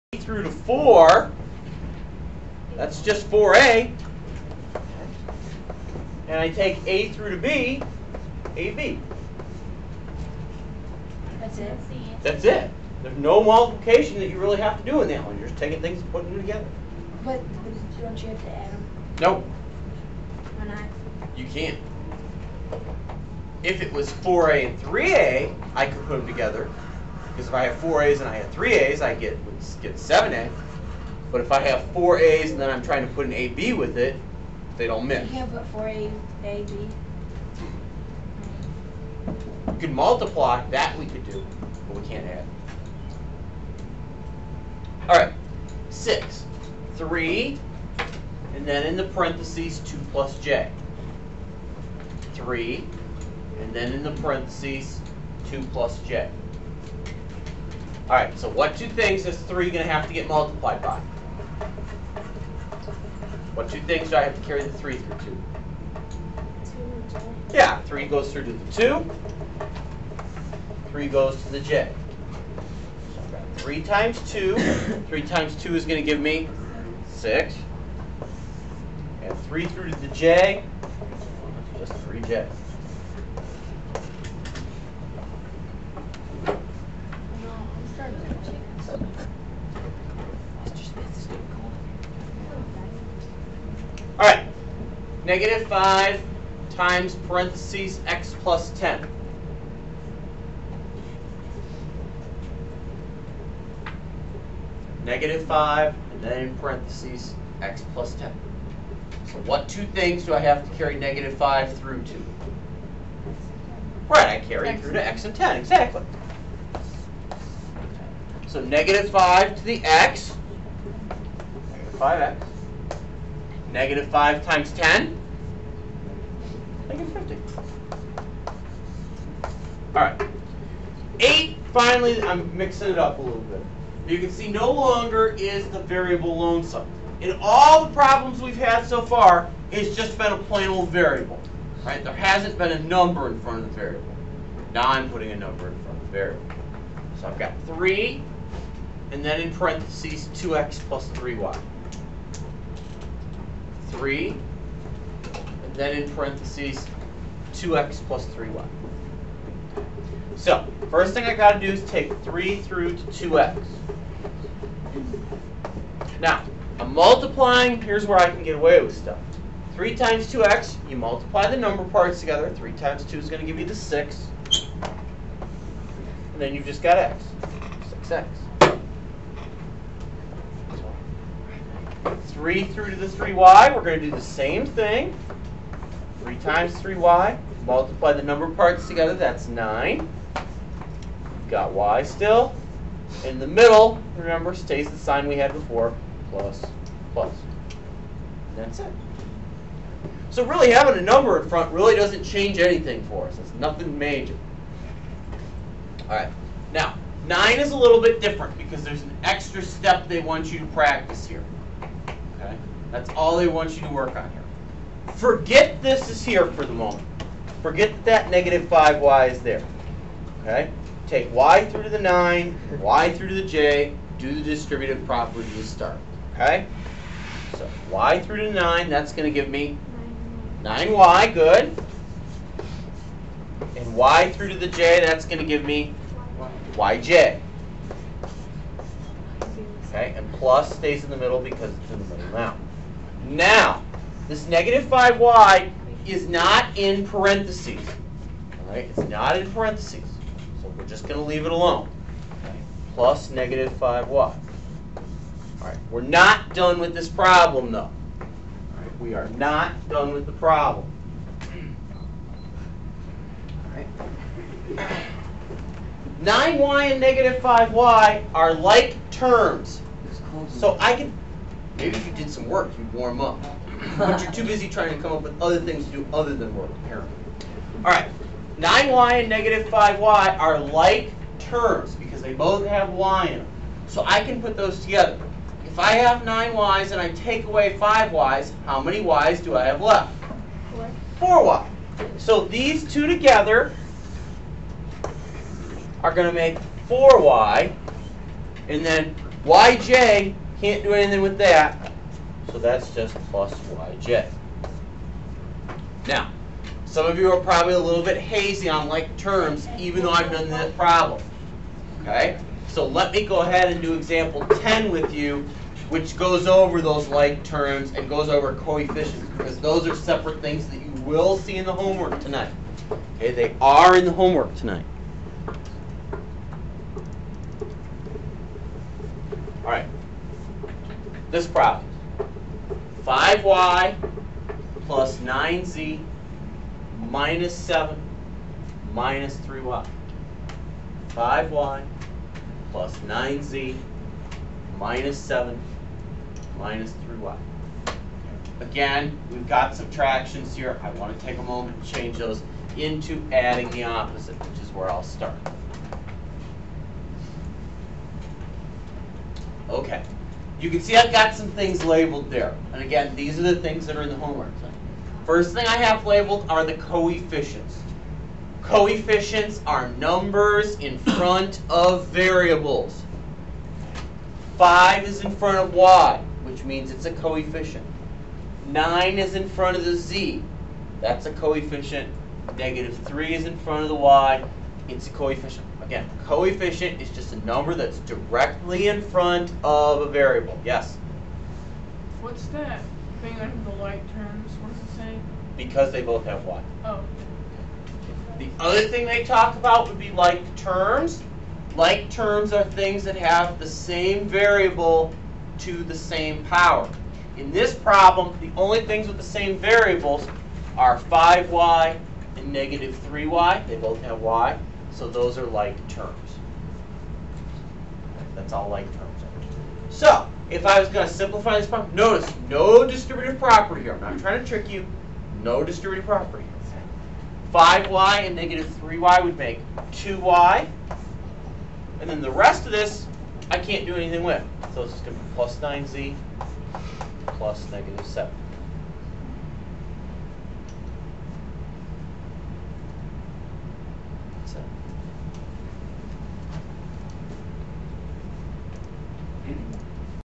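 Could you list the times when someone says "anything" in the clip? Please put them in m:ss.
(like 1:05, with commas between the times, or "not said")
3:22, 5:00, 7:13.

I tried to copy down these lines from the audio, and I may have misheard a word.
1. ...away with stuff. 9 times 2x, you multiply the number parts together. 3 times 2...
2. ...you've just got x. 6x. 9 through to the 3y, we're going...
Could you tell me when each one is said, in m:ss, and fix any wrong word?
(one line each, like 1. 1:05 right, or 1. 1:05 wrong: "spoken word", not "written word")
1. 2:48 wrong: "3", not "9"
2. 2:56 wrong: "3", not "9".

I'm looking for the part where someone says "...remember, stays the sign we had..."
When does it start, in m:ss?
3:14.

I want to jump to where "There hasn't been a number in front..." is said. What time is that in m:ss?
2:22.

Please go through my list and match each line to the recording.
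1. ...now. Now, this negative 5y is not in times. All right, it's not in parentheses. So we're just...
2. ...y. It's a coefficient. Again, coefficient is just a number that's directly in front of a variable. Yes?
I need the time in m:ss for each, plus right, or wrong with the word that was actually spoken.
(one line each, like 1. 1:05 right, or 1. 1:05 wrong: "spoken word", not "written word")
1. 4:02 wrong: "parentheses", not "times"
2. 6:23 right.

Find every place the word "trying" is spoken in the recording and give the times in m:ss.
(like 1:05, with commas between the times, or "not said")
0:32, 4:34, 7:04.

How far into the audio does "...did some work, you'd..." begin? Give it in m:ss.
4:32.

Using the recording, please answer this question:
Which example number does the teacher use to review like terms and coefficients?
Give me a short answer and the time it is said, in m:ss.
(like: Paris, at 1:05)
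10, at 5:13.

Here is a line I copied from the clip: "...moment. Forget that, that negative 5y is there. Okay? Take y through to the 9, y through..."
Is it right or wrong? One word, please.
right.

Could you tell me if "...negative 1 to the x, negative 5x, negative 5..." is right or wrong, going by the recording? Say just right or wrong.
wrong.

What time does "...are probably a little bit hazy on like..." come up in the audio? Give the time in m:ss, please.
5:07.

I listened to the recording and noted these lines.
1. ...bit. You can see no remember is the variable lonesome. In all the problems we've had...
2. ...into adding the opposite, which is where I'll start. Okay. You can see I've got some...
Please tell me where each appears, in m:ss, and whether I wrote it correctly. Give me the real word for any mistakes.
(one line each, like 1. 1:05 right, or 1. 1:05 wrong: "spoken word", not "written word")
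1. 2:13 wrong: "longer", not "remember"
2. 5:52 right.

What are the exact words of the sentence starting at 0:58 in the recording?
All right, so what two things is 3 going to have to get multiplied by?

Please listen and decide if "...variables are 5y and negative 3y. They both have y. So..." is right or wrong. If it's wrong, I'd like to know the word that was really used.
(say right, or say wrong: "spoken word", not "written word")
right.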